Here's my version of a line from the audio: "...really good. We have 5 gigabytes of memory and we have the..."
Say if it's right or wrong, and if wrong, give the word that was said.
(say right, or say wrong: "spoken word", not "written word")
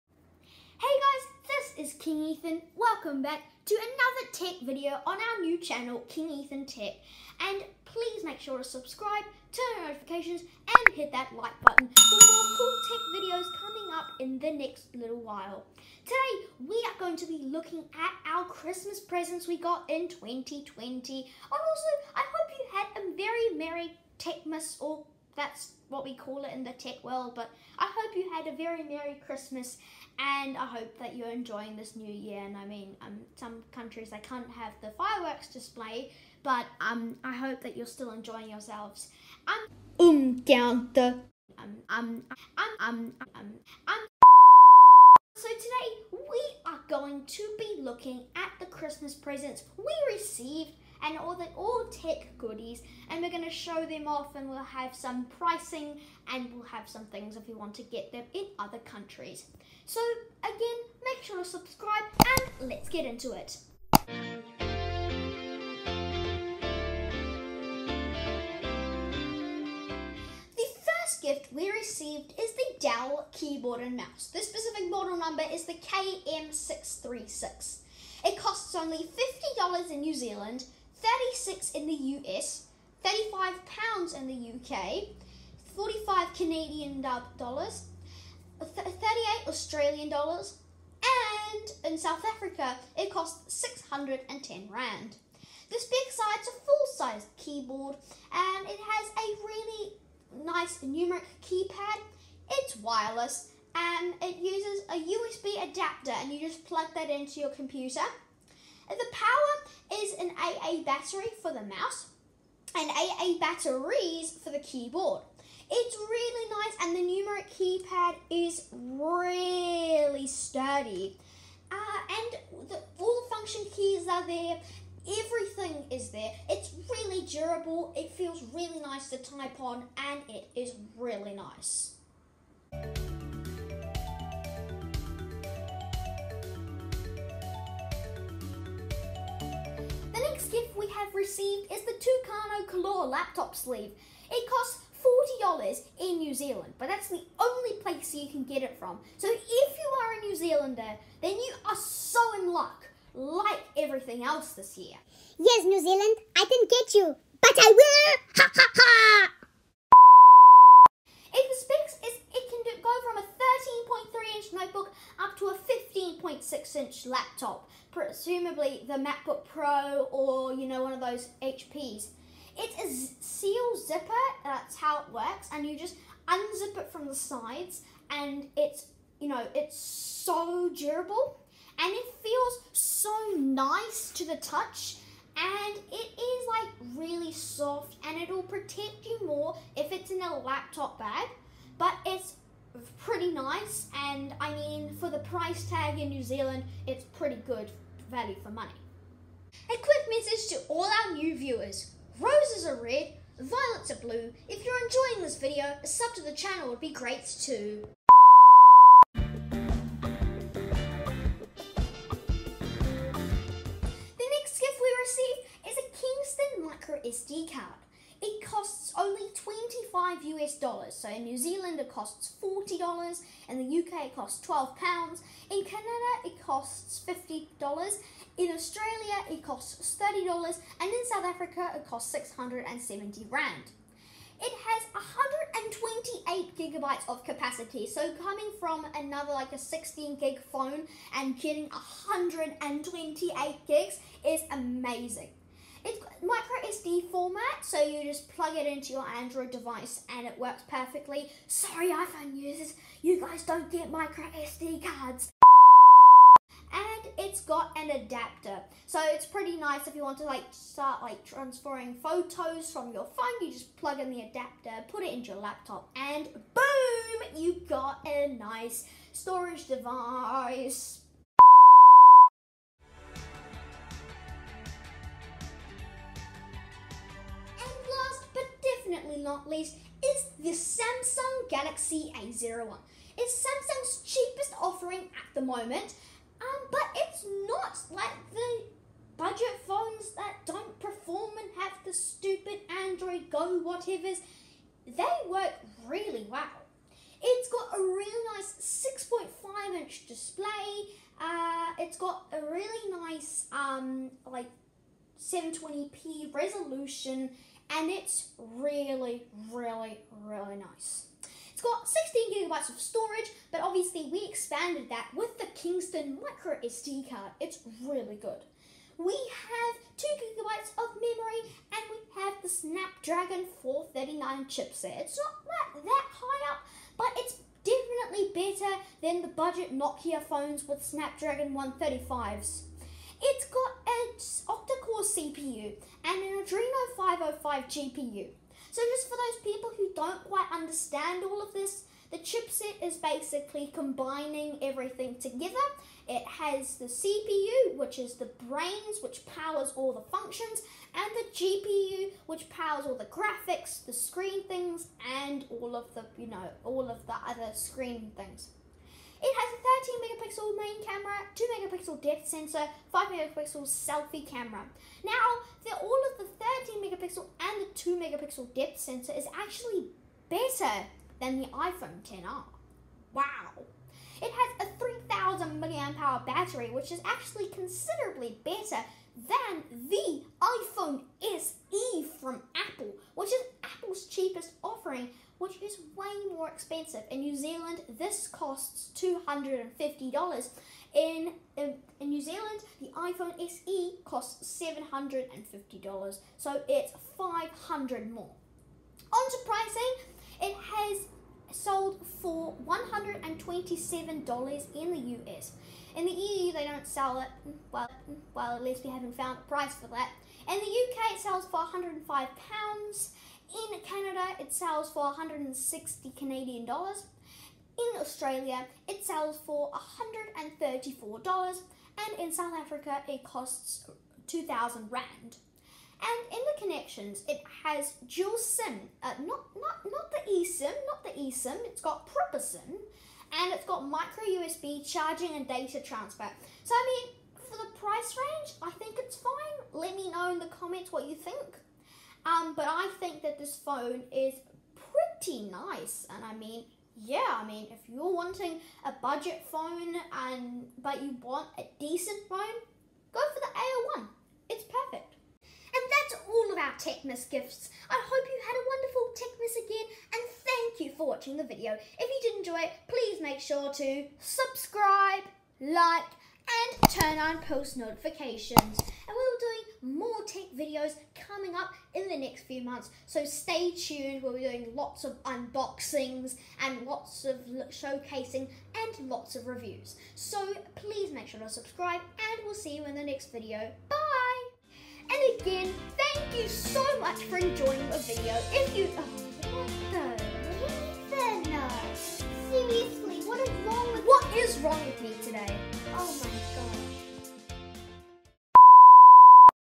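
wrong: "2", not "5".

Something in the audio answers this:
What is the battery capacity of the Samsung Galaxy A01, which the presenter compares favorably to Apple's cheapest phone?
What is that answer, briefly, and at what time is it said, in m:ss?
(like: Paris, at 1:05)
3000 milliamp hours, at 6:14.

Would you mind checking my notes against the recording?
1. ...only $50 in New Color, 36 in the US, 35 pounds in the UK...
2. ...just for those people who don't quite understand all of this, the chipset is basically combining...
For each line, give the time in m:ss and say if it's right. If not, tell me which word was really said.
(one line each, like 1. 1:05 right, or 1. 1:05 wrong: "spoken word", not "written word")
1. 1:18 wrong: "Zealand", not "Color"
2. 5:38 right.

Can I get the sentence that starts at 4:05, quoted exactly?
It's micro SD format, so you just plug it into your Android device and it works perfectly.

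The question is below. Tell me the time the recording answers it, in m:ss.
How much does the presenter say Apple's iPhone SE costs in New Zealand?
6:34.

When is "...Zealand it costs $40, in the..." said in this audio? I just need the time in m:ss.
3:41.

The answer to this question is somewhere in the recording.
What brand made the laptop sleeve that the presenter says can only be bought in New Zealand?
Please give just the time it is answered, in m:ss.
2:21.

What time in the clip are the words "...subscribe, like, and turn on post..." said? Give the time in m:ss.
7:44.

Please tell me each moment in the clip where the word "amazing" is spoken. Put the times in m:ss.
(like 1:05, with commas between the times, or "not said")
4:04.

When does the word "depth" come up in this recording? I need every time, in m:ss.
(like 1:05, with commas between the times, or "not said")
6:02, 6:08.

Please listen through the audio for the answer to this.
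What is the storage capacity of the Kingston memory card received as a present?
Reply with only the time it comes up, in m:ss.
3:54.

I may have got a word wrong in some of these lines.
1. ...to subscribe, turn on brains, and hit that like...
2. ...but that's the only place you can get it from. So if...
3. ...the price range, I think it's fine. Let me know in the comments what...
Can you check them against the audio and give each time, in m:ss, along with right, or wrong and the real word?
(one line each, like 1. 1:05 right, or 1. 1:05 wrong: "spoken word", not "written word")
1. 0:08 wrong: "notifications", not "brains"
2. 2:26 right
3. 7:17 right.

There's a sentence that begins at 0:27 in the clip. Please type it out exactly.
But I hope you had a very Merry Christmas and I hope that you're enjoying this new year.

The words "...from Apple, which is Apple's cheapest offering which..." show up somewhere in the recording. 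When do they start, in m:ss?
6:22.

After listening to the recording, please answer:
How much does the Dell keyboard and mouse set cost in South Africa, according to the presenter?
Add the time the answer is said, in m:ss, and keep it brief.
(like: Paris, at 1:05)
610 rand, at 1:33.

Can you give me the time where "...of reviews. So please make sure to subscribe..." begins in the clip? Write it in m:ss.
7:59.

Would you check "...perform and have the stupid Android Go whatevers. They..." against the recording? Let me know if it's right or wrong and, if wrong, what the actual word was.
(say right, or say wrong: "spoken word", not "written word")
right.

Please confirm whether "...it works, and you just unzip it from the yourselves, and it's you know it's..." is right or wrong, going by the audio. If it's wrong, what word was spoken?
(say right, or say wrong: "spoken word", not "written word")
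wrong: "sides", not "yourselves".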